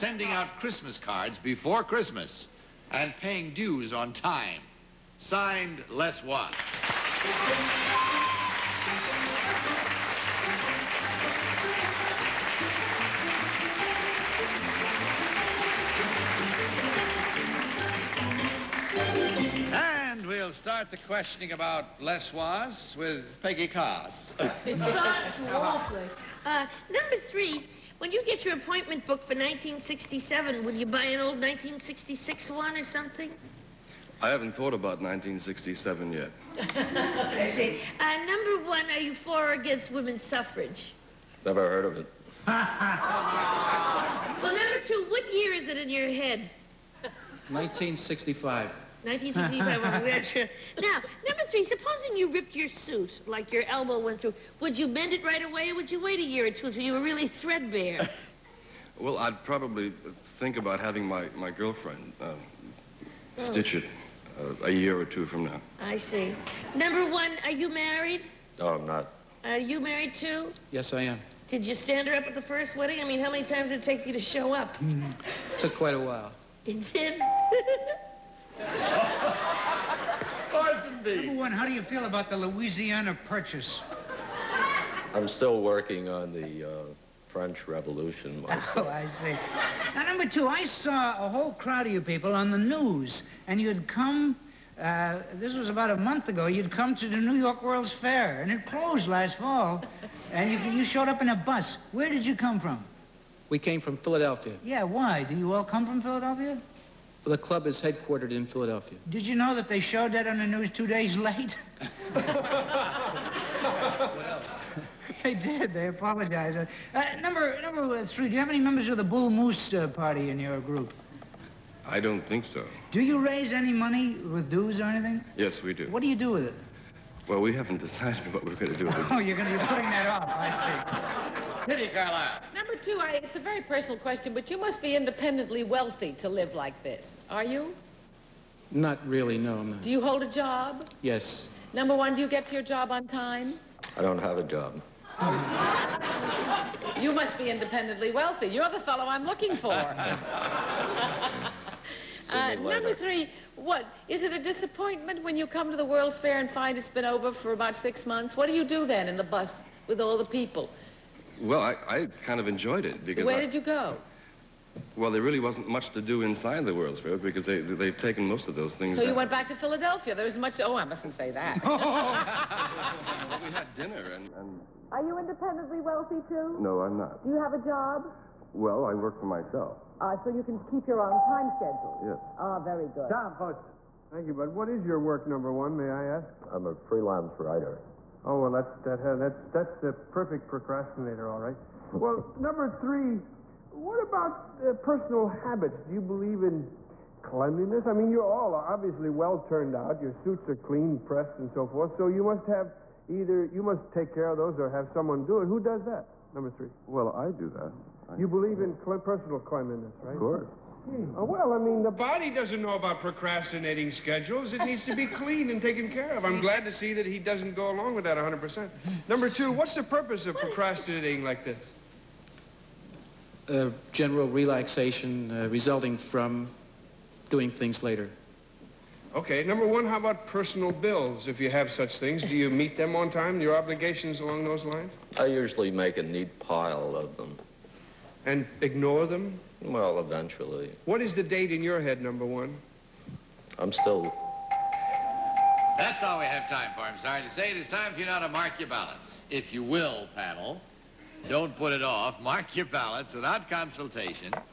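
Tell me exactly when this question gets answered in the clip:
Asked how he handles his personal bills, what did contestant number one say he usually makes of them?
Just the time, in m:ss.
3:55.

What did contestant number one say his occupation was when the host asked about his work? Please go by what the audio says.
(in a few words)
Freelance writer.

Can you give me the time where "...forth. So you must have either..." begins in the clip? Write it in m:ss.
3:21.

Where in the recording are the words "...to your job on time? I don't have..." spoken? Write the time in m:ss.
2:22.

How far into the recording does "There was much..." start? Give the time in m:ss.
2:50.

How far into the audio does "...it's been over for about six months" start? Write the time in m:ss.
2:36.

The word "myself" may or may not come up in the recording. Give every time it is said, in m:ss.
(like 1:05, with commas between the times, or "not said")
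1:28, 2:59.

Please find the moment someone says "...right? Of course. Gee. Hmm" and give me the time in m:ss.
3:30.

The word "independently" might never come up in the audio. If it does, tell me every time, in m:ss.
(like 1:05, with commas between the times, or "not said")
2:14, 2:27, 2:55.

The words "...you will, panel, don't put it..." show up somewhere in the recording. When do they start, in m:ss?
4:09.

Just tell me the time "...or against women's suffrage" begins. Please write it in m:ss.
0:39.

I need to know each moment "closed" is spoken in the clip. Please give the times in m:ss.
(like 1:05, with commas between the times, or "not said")
1:38.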